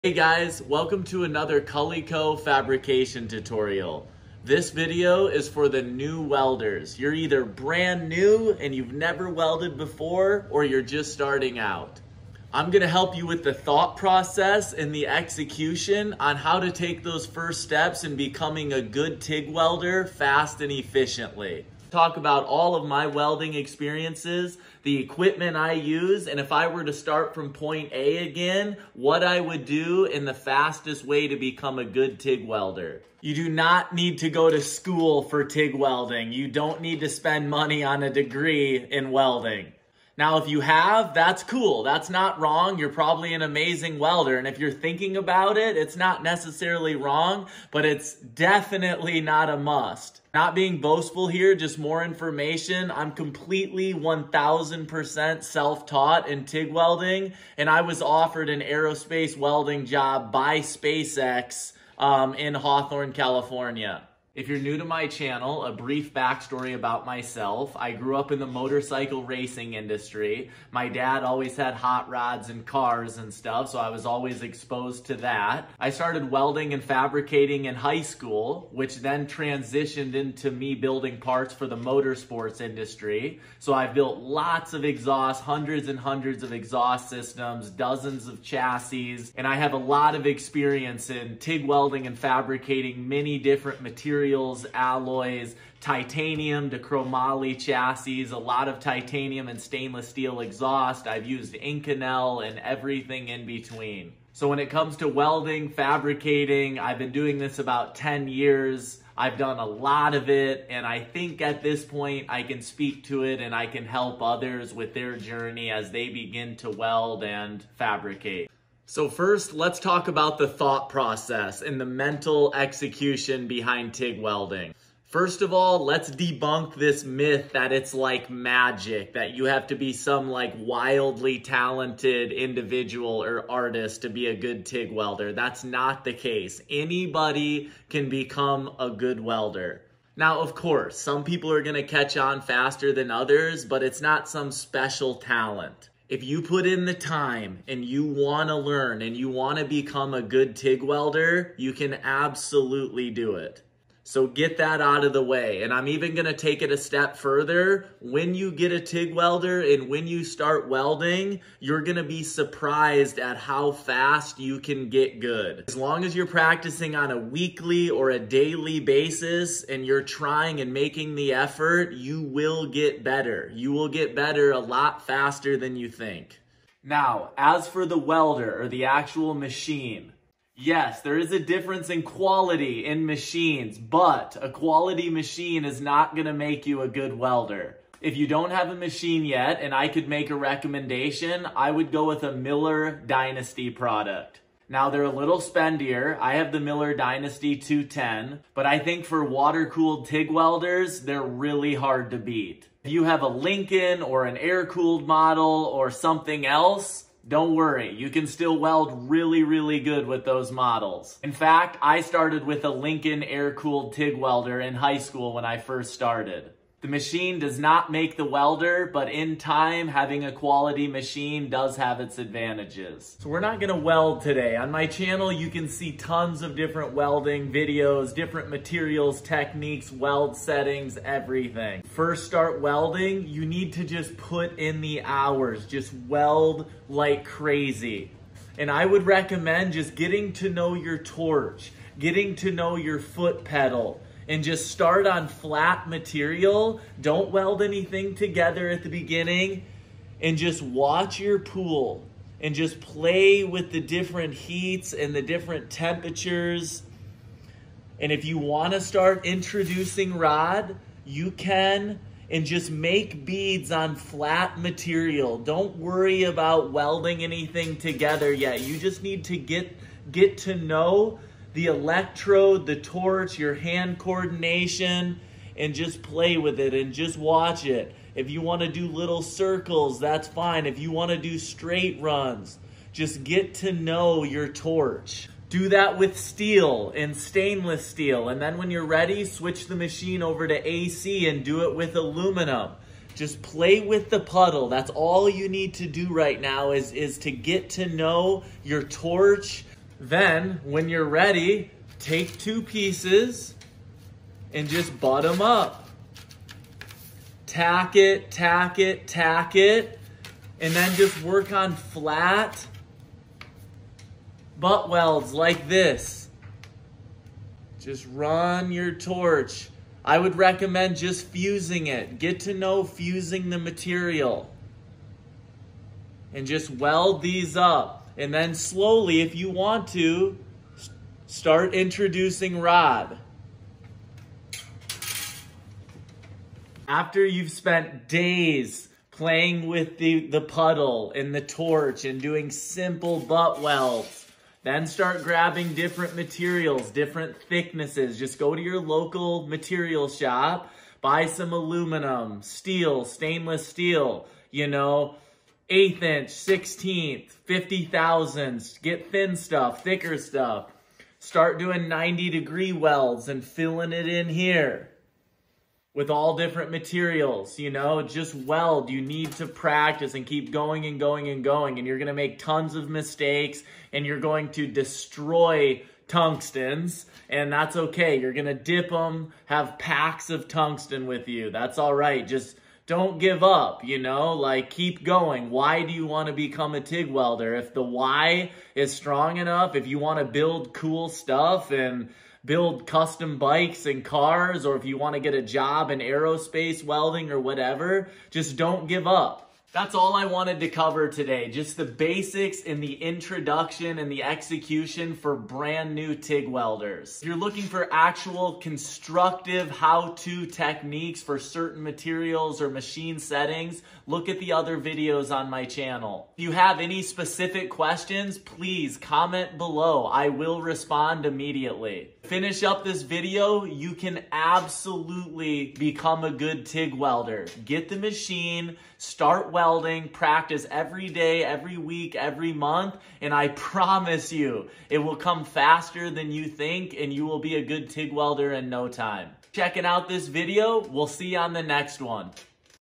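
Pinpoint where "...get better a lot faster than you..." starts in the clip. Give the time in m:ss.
2:53.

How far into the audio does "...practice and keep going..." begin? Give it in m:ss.
6:09.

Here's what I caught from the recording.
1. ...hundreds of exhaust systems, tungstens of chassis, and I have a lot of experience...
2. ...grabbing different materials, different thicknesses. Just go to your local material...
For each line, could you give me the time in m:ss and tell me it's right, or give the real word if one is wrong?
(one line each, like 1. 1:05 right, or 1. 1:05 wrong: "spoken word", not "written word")
1. 1:25 wrong: "dozens", not "tungstens"
2. 5:45 right.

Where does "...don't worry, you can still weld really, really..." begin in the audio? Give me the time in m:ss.
3:27.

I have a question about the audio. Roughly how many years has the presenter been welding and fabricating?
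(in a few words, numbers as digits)
10 years.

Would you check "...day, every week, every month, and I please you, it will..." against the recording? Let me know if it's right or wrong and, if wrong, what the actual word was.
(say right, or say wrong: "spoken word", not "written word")
wrong: "promise", not "please".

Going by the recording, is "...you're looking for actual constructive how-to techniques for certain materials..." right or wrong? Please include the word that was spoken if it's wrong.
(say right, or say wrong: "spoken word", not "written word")
right.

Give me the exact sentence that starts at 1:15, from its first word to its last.
I started welding and fabricating in high school, which then transitioned into me building parts for the motorsports industry.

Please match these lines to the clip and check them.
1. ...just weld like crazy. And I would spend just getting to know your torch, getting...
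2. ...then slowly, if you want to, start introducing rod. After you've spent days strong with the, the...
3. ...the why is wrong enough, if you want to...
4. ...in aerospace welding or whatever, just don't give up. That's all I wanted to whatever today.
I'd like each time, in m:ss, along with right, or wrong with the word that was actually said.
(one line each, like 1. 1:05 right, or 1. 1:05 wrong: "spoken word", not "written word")
1. 3:55 wrong: "recommend", not "spend"
2. 5:28 wrong: "playing", not "strong"
3. 6:27 wrong: "strong", not "wrong"
4. 6:35 wrong: "cover", not "whatever".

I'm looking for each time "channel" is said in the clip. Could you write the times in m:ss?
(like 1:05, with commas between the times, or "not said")
1:05, 3:44, 6:55.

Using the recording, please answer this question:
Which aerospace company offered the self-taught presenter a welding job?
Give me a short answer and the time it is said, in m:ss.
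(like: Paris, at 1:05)
SpaceX, at 1:00.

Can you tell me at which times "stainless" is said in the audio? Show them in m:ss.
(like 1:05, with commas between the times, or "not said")
1:39, 4:47, 5:53.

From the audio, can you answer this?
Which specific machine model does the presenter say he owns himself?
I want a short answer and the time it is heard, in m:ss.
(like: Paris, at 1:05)
Miller Dynasty 210, at 3:16.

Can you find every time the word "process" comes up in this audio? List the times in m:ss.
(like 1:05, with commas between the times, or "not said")
0:13, 2:00.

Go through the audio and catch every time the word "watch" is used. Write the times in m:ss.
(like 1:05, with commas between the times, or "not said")
4:10, 4:37.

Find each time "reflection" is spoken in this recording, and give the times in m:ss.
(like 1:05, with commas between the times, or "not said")
not said.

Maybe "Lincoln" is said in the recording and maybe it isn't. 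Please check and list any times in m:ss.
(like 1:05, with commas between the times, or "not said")
3:23, 3:32.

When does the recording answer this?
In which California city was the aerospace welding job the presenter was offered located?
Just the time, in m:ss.
1:02.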